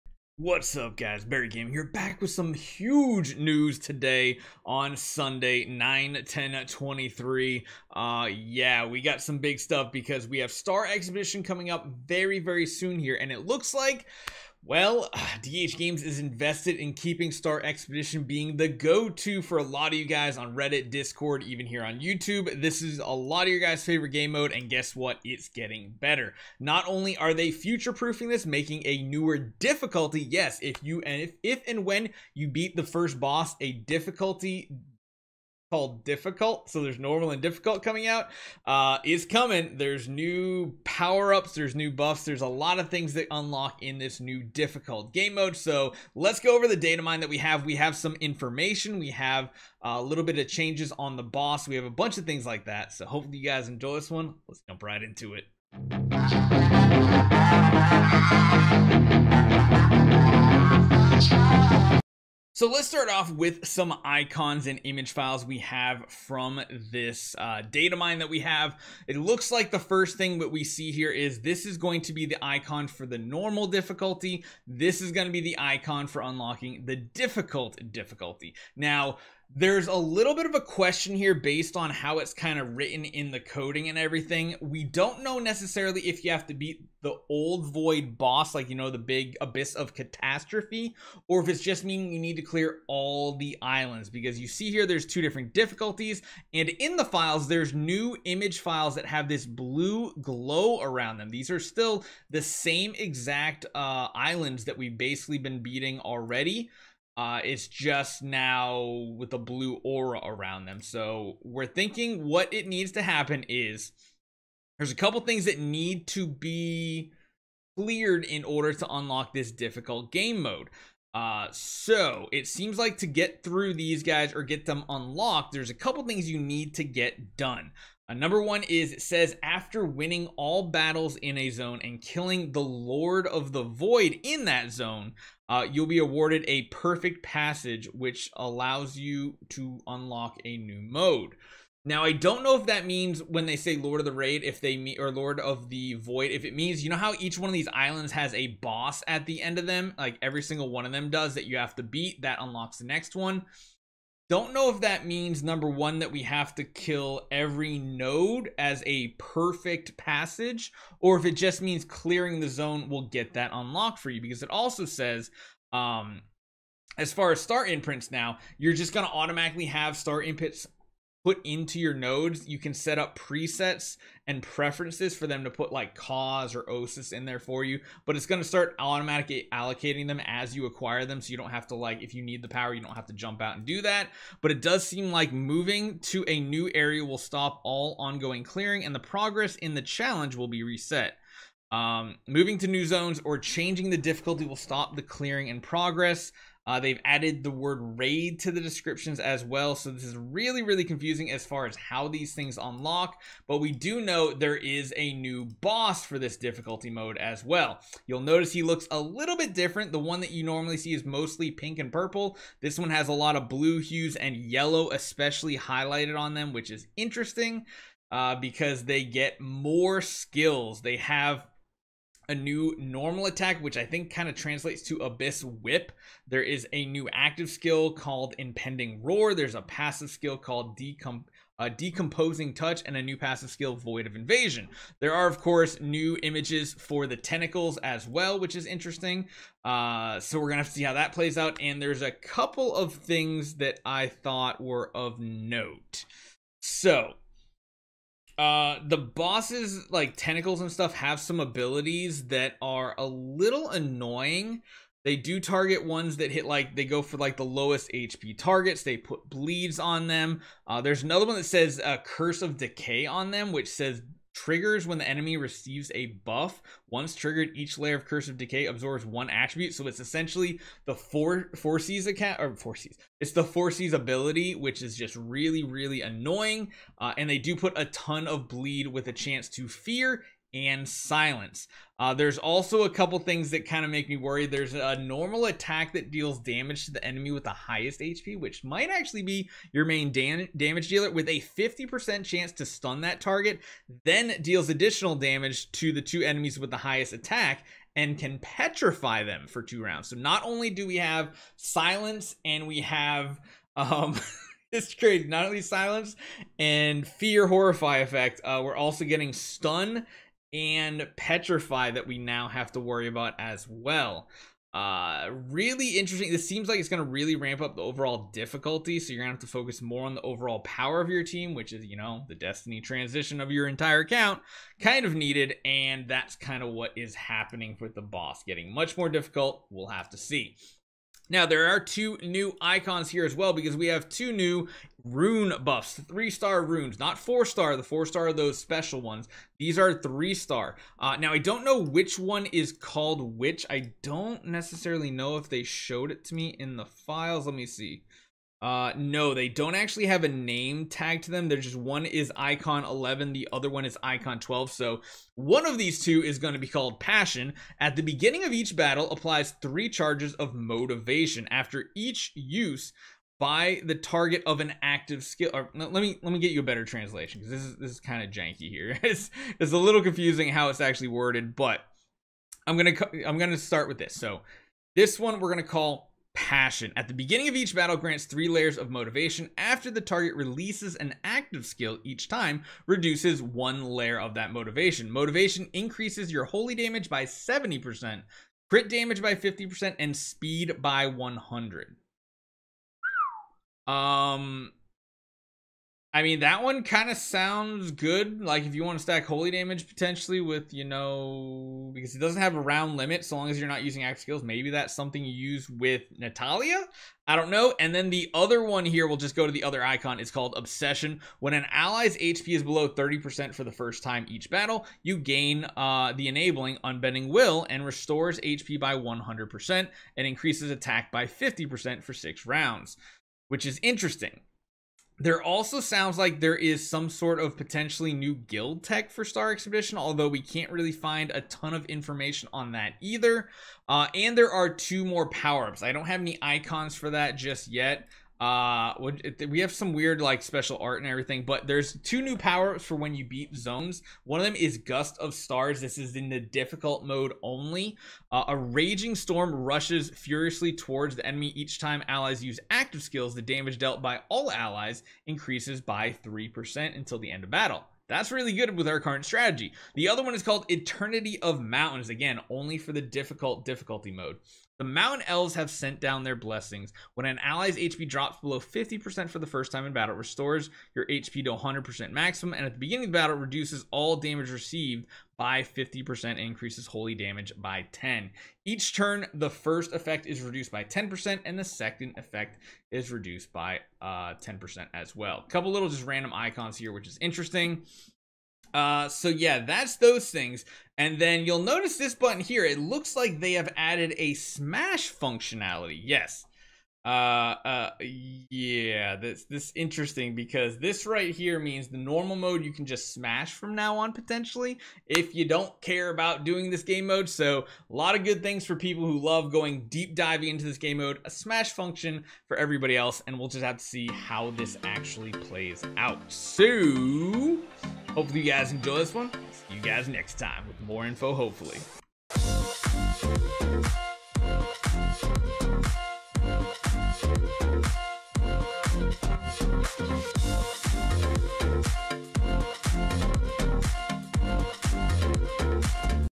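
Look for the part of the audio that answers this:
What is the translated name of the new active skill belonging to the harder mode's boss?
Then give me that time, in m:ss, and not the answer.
3:48.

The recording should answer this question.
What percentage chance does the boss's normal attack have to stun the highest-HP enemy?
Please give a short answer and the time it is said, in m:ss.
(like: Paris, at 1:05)
50%, at 4:51.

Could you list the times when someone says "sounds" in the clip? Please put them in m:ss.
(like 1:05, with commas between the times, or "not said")
6:37, 7:05.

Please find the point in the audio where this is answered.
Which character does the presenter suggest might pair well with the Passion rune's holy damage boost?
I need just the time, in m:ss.
6:46.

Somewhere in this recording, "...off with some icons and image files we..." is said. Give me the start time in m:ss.
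1:03.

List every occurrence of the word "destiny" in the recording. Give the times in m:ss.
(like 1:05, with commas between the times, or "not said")
5:22.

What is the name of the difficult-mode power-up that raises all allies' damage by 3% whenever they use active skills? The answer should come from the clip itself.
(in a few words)
Gust of Stars.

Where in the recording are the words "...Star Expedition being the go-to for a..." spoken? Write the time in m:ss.
0:17.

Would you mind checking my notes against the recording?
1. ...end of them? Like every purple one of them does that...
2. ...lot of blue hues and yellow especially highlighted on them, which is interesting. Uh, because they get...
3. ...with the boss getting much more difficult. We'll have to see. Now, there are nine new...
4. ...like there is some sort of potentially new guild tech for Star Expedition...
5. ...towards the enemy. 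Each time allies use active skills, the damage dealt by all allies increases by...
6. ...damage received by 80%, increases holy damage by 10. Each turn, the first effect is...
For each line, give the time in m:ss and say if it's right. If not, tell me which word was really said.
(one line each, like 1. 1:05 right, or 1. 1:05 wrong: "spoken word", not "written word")
1. 2:29 wrong: "single", not "purple"
2. 3:33 right
3. 5:27 wrong: "two", not "nine"
4. 7:06 right
5. 7:30 right
6. 7:54 wrong: "50", not "80".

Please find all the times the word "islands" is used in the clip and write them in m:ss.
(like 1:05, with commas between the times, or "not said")
1:33, 1:44, 2:27.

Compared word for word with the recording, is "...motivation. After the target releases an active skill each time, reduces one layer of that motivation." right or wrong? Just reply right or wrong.
right.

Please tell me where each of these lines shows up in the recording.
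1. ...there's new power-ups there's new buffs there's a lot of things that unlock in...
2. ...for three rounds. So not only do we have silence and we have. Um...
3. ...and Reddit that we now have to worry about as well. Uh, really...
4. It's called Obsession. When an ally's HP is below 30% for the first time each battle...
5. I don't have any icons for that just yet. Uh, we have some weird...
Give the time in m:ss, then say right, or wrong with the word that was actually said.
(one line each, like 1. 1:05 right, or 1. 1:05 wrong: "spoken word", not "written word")
1. 0:39 right
2. 4:59 wrong: "two", not "three"
3. 5:10 wrong: "Petrify", not "Reddit"
4. 6:50 right
5. 7:15 right.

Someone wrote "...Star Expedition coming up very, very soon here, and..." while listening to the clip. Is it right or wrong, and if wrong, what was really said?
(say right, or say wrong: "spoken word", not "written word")
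right.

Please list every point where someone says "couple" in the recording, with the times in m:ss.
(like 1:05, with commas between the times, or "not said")
1:54, 2:05, 4:02, 4:42, 8:05.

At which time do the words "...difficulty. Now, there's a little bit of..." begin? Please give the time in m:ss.
1:17.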